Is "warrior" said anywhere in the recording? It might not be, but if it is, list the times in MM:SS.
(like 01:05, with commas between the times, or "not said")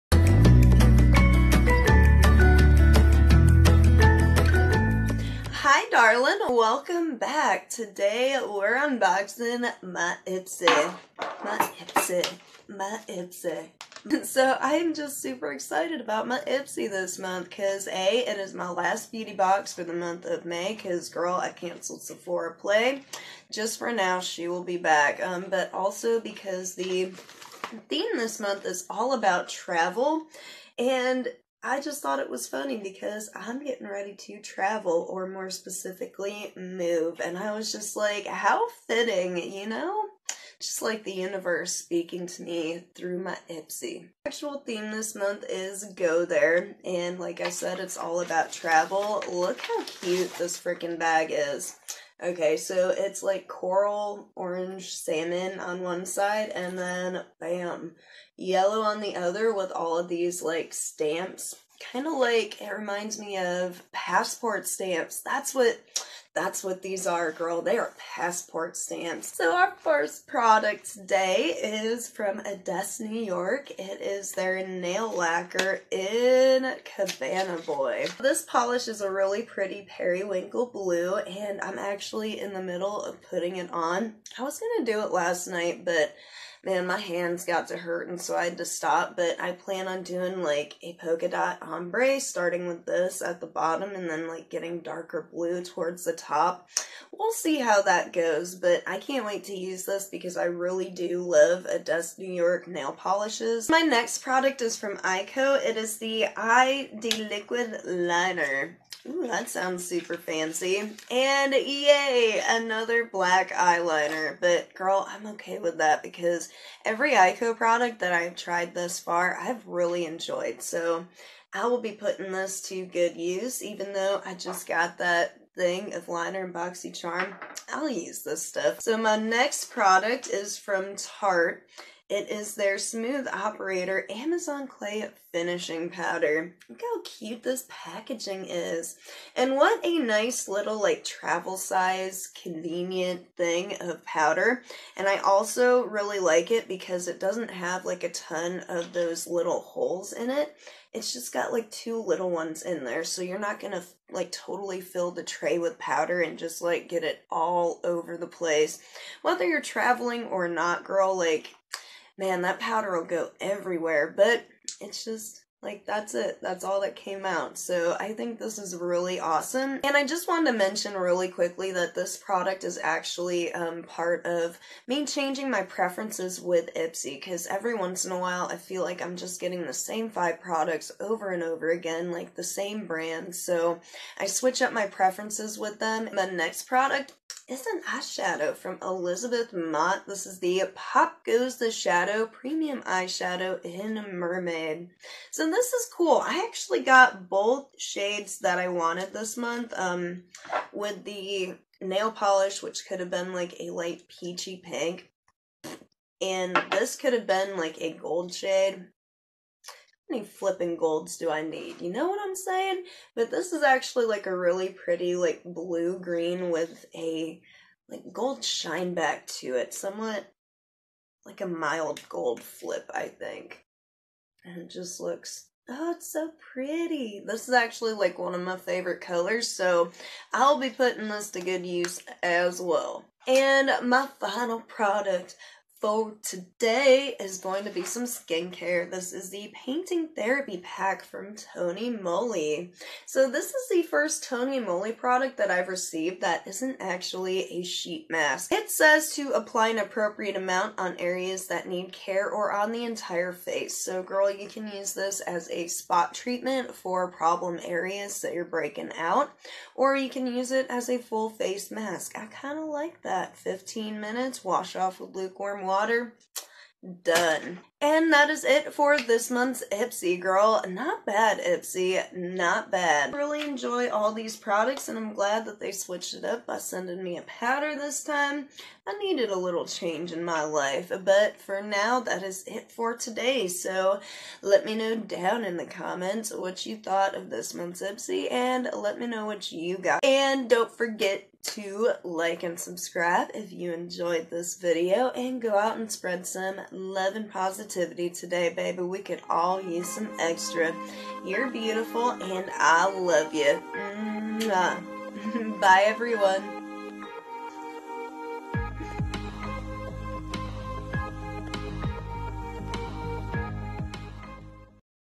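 not said.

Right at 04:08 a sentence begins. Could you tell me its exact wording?
It says to apply an appropriate amount on areas that need care or on the entire face.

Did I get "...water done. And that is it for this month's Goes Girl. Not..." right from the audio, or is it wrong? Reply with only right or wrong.
wrong.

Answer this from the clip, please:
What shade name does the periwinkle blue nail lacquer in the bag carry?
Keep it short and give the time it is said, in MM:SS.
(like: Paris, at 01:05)
Cabana Boy, at 01:16.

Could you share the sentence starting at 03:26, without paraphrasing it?
And this could have been like a gold shade.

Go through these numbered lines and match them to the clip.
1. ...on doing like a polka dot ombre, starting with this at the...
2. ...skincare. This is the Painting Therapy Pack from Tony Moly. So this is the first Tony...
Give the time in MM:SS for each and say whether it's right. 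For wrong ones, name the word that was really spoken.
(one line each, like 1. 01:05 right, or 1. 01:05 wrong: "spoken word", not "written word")
1. 01:29 right
2. 03:58 right.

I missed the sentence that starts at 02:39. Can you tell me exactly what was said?
Whether you're traveling or not, girl, like man, that powder will go everywhere, but it's just like, that's it.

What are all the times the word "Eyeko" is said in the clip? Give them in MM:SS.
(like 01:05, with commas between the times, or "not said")
01:44, 01:57.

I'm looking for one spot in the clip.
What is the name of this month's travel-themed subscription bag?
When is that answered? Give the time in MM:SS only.
00:45.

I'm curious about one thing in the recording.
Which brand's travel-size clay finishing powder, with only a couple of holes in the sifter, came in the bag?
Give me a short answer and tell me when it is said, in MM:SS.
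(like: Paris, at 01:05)
Tarte, at 02:10.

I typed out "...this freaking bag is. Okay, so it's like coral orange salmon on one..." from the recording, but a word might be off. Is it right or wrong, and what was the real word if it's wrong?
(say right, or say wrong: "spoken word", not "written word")
right.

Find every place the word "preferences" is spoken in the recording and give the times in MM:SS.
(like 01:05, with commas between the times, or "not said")
02:55, 03:04.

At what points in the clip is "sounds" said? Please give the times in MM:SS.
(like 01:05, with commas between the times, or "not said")
01:49.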